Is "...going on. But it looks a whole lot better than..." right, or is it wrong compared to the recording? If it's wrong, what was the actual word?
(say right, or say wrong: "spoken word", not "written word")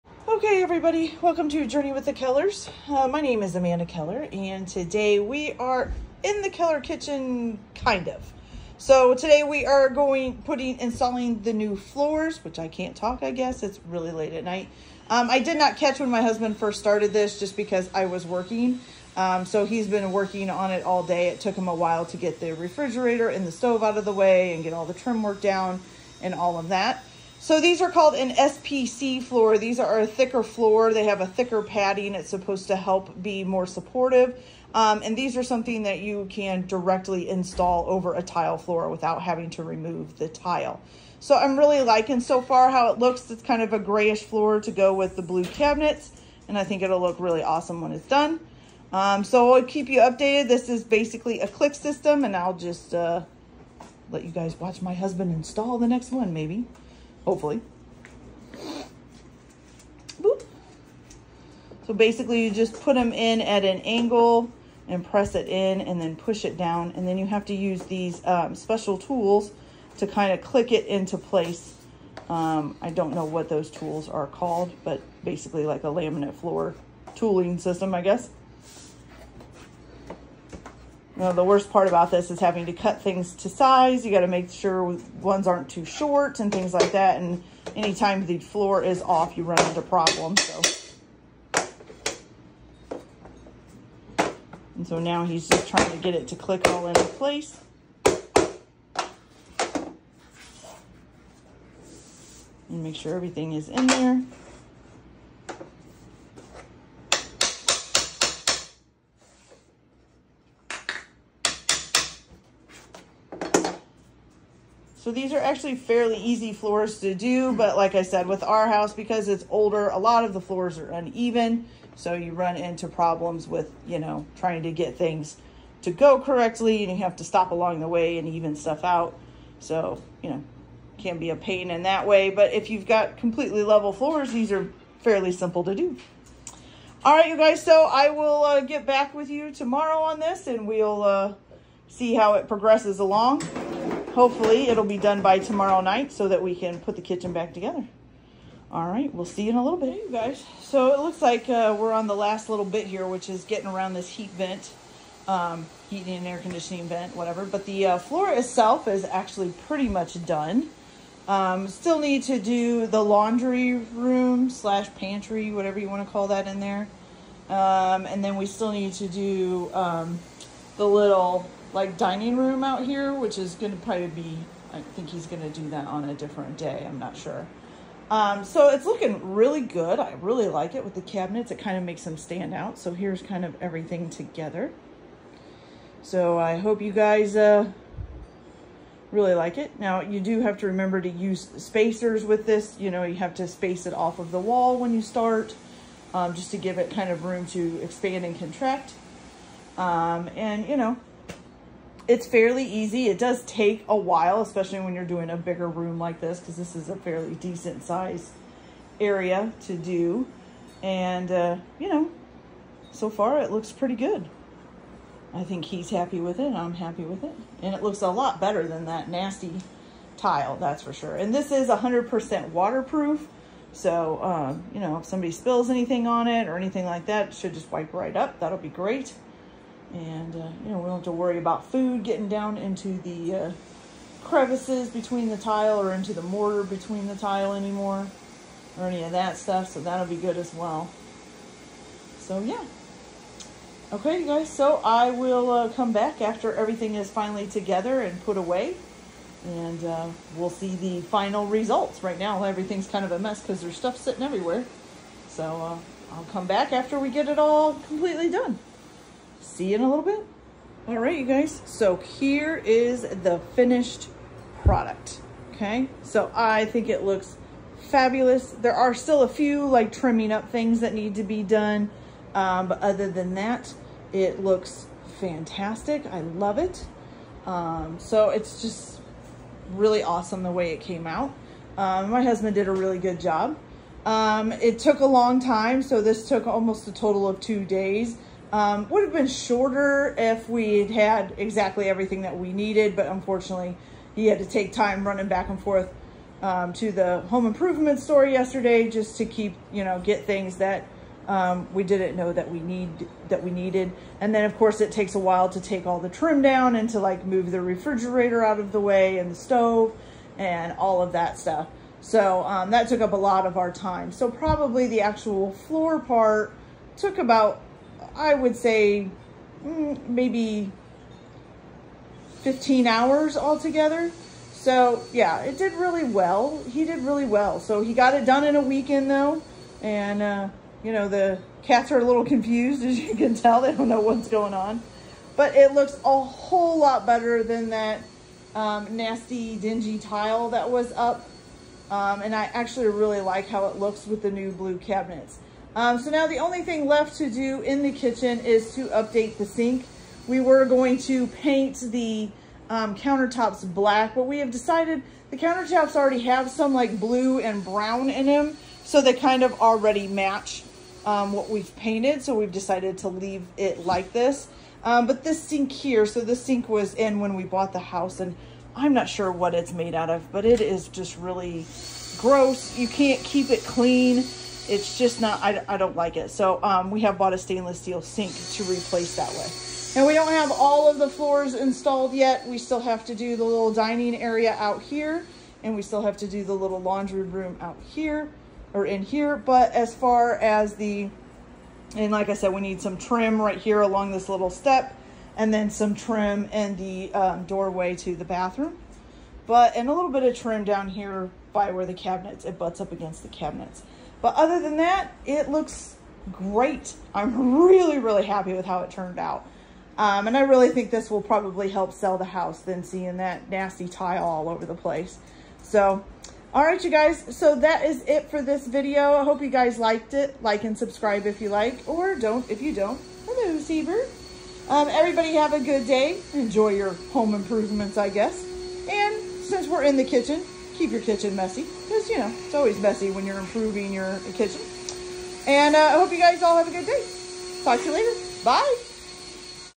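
right.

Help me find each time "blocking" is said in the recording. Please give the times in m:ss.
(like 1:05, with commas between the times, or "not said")
not said.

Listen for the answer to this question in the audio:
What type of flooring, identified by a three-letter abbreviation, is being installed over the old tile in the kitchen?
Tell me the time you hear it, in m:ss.
0:28.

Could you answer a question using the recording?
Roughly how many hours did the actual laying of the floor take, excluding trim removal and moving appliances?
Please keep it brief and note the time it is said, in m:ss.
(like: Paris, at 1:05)
15, at 5:22.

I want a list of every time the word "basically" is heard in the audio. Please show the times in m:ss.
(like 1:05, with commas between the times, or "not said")
0:50, 1:01, 1:15.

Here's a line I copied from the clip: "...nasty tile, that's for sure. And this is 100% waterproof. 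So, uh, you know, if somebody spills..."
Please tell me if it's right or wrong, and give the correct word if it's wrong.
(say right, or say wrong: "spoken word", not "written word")
right.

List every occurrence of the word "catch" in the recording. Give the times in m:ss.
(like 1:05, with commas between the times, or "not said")
0:15.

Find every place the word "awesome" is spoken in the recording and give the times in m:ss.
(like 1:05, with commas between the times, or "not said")
0:47, 4:40.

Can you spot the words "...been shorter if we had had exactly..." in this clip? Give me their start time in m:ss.
4:49.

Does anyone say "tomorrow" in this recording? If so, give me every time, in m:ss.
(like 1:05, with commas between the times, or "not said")
2:19, 2:25.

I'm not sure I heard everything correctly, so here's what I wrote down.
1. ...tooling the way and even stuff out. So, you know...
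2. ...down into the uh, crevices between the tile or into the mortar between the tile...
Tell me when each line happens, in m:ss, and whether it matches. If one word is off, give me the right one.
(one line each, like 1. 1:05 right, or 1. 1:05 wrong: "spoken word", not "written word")
1. 2:07 wrong: "along", not "tooling"
2. 3:52 right.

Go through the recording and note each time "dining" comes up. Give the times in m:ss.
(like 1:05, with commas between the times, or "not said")
2:51, 6:23.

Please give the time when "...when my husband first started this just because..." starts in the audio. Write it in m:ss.
0:15.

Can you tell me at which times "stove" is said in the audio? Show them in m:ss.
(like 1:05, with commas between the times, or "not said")
0:23, 5:09.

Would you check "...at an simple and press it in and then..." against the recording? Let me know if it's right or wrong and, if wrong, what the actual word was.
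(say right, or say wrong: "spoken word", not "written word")
wrong: "angle", not "simple".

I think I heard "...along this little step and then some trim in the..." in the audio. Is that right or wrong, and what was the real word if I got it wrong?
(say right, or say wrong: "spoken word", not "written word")
right.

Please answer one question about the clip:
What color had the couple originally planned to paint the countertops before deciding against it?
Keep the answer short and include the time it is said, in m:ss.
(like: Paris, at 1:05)
Black, at 5:53.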